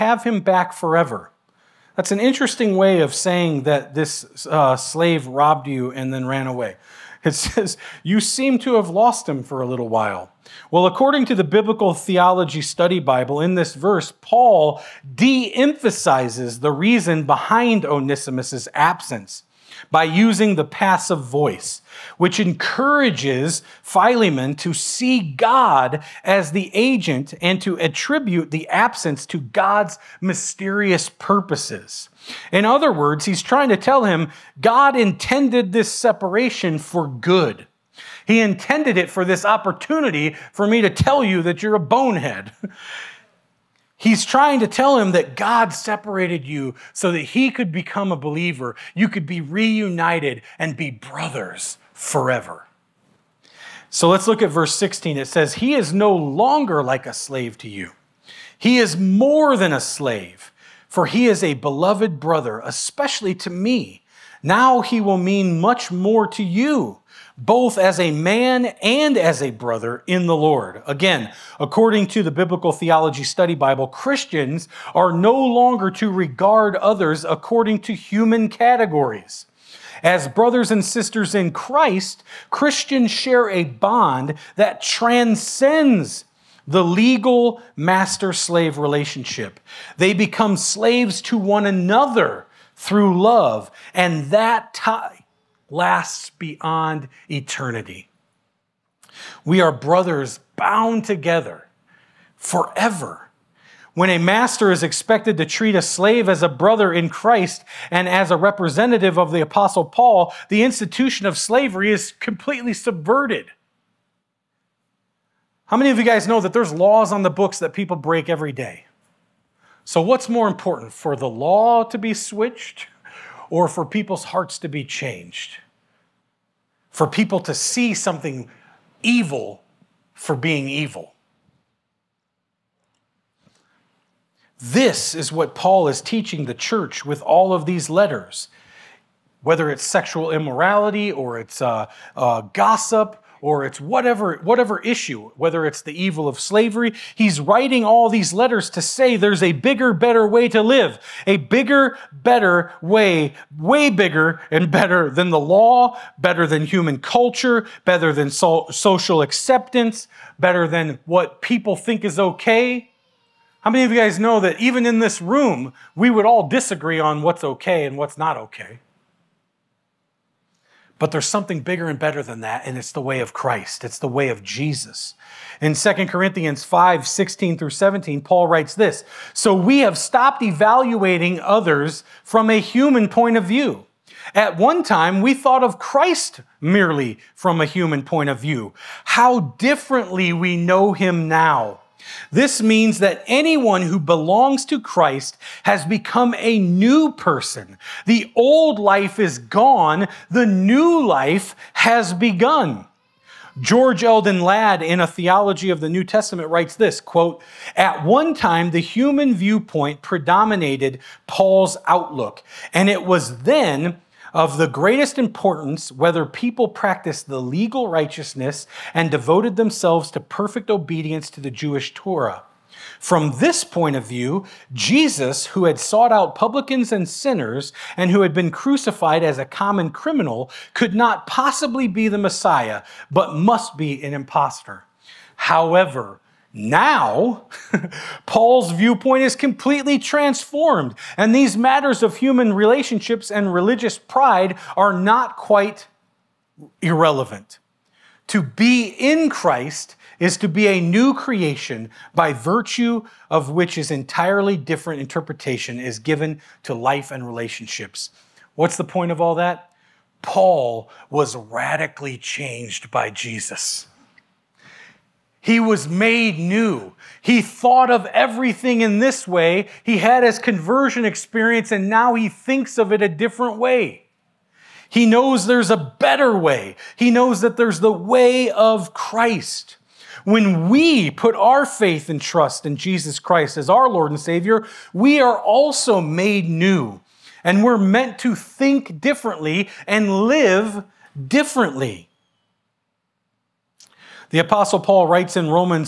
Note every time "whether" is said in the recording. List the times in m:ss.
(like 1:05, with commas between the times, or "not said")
2:19, 2:25, 3:35.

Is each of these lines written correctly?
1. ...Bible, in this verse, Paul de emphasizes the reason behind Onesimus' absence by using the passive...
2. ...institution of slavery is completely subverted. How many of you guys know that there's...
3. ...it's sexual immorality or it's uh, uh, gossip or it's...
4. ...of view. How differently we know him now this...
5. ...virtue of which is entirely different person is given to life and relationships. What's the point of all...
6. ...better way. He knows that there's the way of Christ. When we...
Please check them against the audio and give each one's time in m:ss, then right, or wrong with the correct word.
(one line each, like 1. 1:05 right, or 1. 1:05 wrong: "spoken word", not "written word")
1. 0:12 right
2. 1:50 right
3. 2:19 right
4. 3:08 right
5. 4:12 wrong: "interpretation", not "person"
6. 4:35 right.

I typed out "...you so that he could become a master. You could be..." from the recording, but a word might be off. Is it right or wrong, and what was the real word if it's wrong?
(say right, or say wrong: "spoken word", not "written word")
wrong: "believer", not "master".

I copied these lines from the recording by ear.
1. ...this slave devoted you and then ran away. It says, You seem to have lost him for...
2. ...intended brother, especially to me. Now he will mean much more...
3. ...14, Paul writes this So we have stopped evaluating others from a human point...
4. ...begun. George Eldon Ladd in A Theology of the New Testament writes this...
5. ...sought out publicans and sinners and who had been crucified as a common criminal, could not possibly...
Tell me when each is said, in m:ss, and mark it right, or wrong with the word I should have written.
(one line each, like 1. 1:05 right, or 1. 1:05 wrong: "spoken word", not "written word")
1. 0:03 wrong: "robbed", not "devoted"
2. 1:01 wrong: "beloved", not "intended"
3. 2:57 wrong: "17", not "14"
4. 3:22 right
5. 3:45 right.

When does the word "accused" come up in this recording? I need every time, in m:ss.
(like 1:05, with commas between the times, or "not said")
not said.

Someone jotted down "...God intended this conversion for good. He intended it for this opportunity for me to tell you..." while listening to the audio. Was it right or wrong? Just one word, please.
wrong.